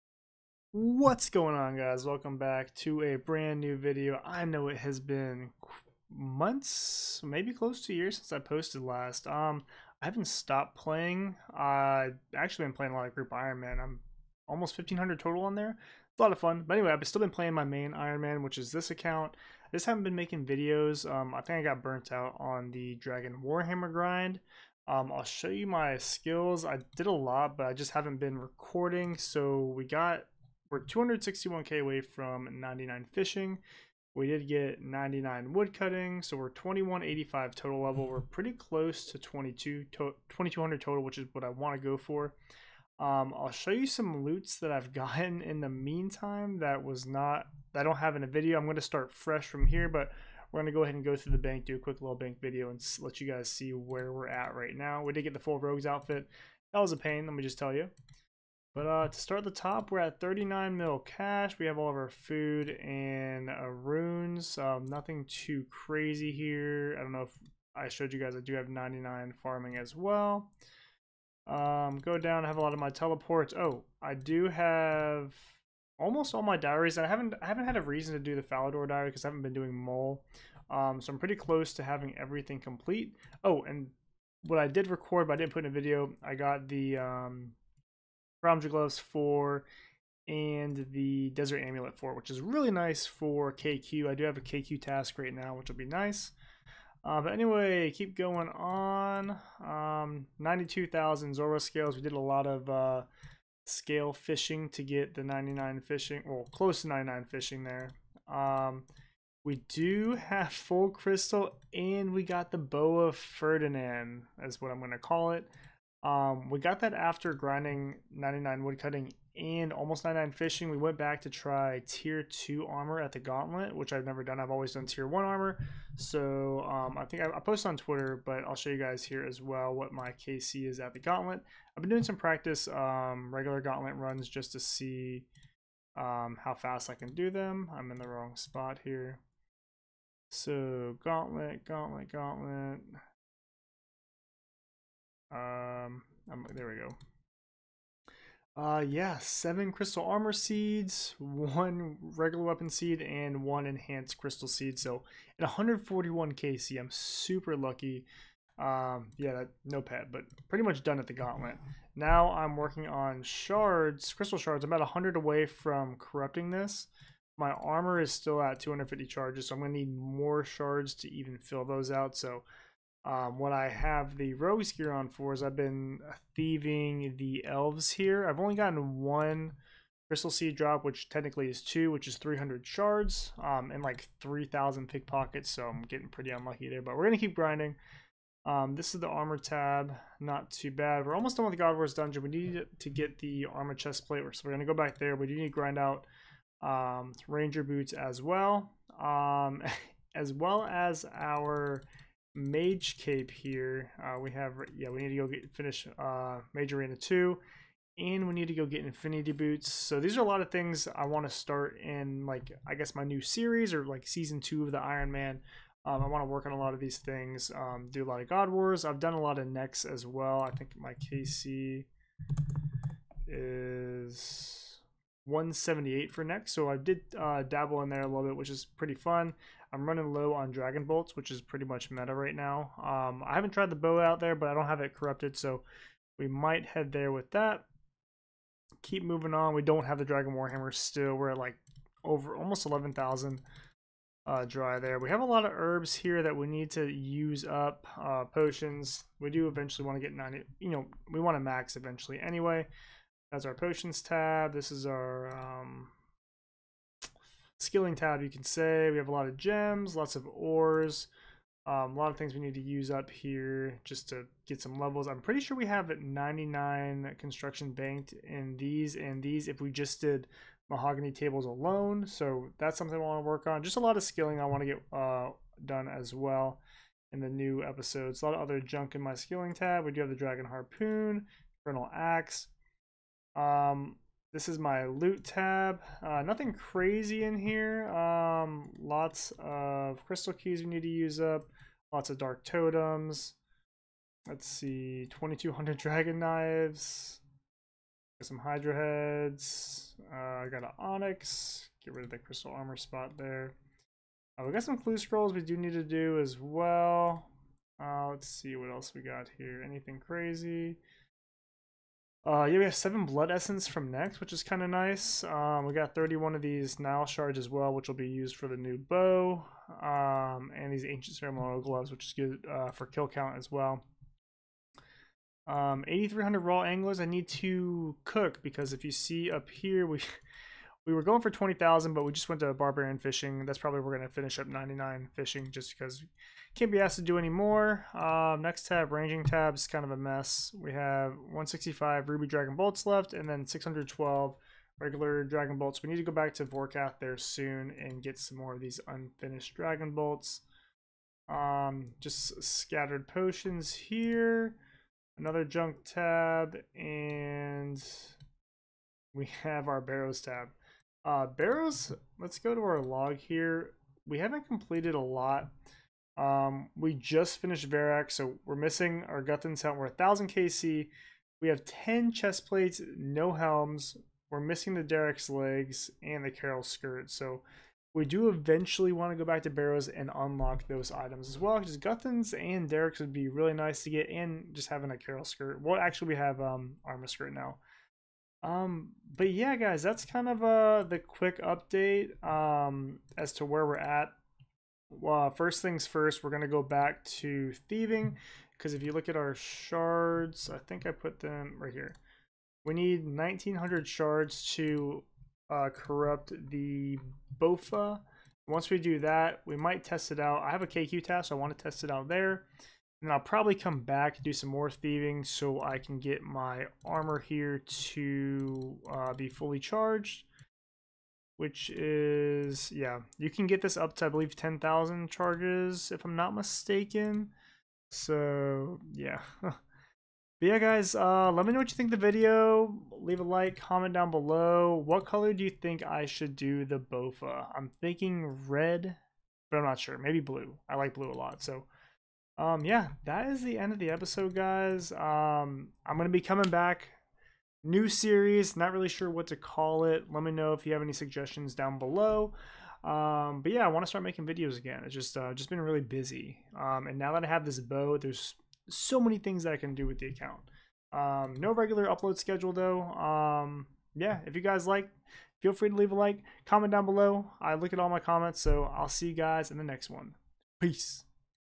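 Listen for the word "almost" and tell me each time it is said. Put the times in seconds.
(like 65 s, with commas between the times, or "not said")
14 s, 75 s, 119 s, 191 s, 242 s.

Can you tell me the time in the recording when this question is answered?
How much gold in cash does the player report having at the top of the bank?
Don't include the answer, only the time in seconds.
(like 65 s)
60 s.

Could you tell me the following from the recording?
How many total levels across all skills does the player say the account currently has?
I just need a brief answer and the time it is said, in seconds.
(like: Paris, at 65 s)
2185, at 36 s.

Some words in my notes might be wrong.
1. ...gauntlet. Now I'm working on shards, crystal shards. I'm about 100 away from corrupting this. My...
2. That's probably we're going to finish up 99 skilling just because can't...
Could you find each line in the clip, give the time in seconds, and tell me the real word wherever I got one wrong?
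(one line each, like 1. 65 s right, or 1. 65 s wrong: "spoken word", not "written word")
1. 161 s right
2. 333 s wrong: "fishing", not "skilling".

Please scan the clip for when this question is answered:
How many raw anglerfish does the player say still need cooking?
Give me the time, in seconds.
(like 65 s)
325 s.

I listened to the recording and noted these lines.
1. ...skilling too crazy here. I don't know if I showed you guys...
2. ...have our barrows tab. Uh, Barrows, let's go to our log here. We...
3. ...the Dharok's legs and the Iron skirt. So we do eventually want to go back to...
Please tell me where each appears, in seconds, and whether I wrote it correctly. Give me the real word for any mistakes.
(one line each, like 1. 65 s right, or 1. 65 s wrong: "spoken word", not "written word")
1. 64 s wrong: "nothing", not "skilling"
2. 359 s right
3. 374 s wrong: "Karil", not "Iron".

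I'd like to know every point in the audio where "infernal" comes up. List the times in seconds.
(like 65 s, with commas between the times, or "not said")
281 s.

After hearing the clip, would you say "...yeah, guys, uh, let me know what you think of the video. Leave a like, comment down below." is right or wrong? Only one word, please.
right.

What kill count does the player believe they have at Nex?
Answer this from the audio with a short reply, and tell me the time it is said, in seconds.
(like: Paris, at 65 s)
178, at 225 s.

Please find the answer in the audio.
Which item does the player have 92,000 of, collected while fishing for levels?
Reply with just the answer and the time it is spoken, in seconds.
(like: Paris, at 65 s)
Zulrah scales, at 101 s.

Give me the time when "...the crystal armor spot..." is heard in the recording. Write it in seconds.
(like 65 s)
302 s.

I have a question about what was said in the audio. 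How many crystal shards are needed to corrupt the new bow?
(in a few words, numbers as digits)
1900.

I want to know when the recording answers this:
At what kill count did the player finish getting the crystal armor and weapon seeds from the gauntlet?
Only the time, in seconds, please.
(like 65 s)
155 s.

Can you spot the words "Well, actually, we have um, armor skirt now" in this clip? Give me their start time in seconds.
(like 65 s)
385 s.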